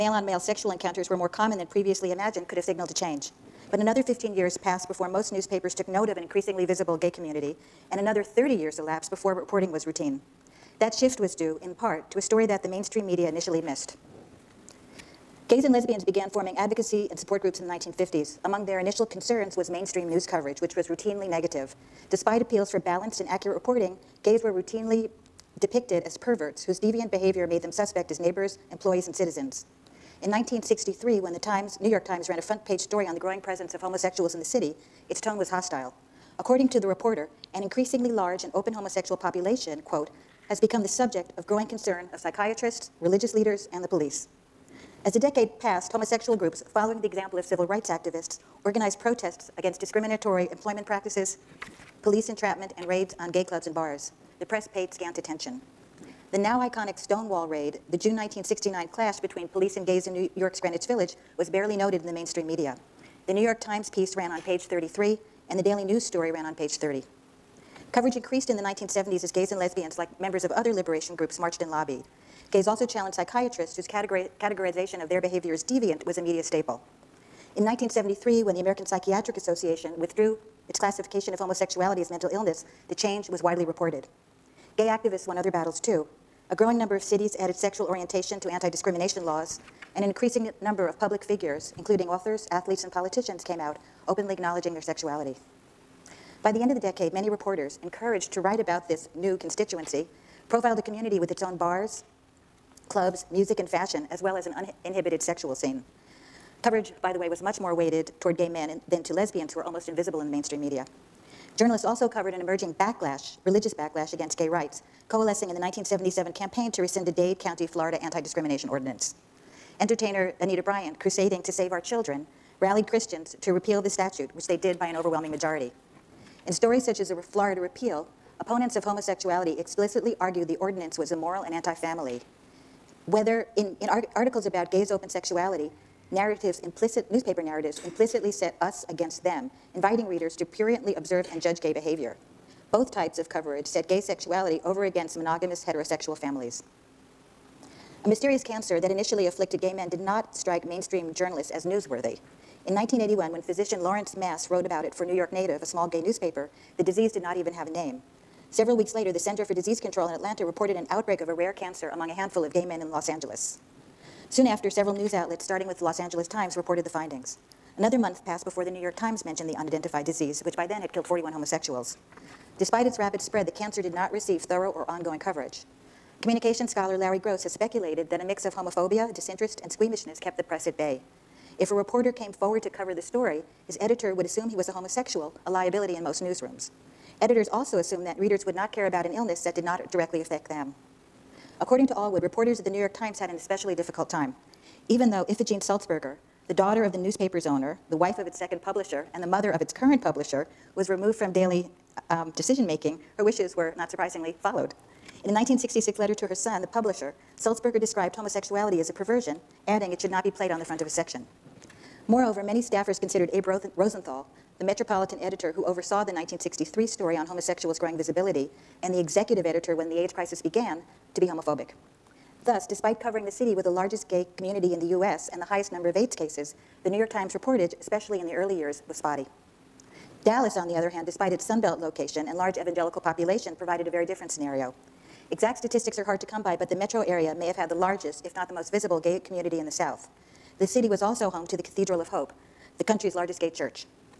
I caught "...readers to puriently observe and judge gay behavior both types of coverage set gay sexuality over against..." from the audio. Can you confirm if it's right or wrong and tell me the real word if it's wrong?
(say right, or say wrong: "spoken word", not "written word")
right.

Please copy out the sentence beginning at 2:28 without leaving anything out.
A mysterious cancer that initially afflicted gay men did not strike mainstream journalists as newsworthy.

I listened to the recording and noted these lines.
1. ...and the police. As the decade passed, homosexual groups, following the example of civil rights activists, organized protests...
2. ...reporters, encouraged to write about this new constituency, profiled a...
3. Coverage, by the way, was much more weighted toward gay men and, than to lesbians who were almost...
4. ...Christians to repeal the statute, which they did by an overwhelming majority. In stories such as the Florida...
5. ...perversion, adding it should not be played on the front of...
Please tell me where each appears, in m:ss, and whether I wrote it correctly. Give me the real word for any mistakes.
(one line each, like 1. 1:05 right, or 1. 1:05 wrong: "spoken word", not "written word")
1. 0:43 right
2. 1:37 right
3. 1:46 right
4. 2:02 right
5. 3:28 right.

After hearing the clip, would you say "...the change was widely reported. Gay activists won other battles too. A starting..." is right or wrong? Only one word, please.
wrong.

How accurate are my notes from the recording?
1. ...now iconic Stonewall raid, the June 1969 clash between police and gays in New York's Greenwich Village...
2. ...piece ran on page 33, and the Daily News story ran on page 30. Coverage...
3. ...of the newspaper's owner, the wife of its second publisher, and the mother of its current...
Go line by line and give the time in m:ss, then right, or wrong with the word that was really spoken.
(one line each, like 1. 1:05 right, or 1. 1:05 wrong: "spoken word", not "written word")
1. 0:56 right
2. 1:03 right
3. 3:16 right.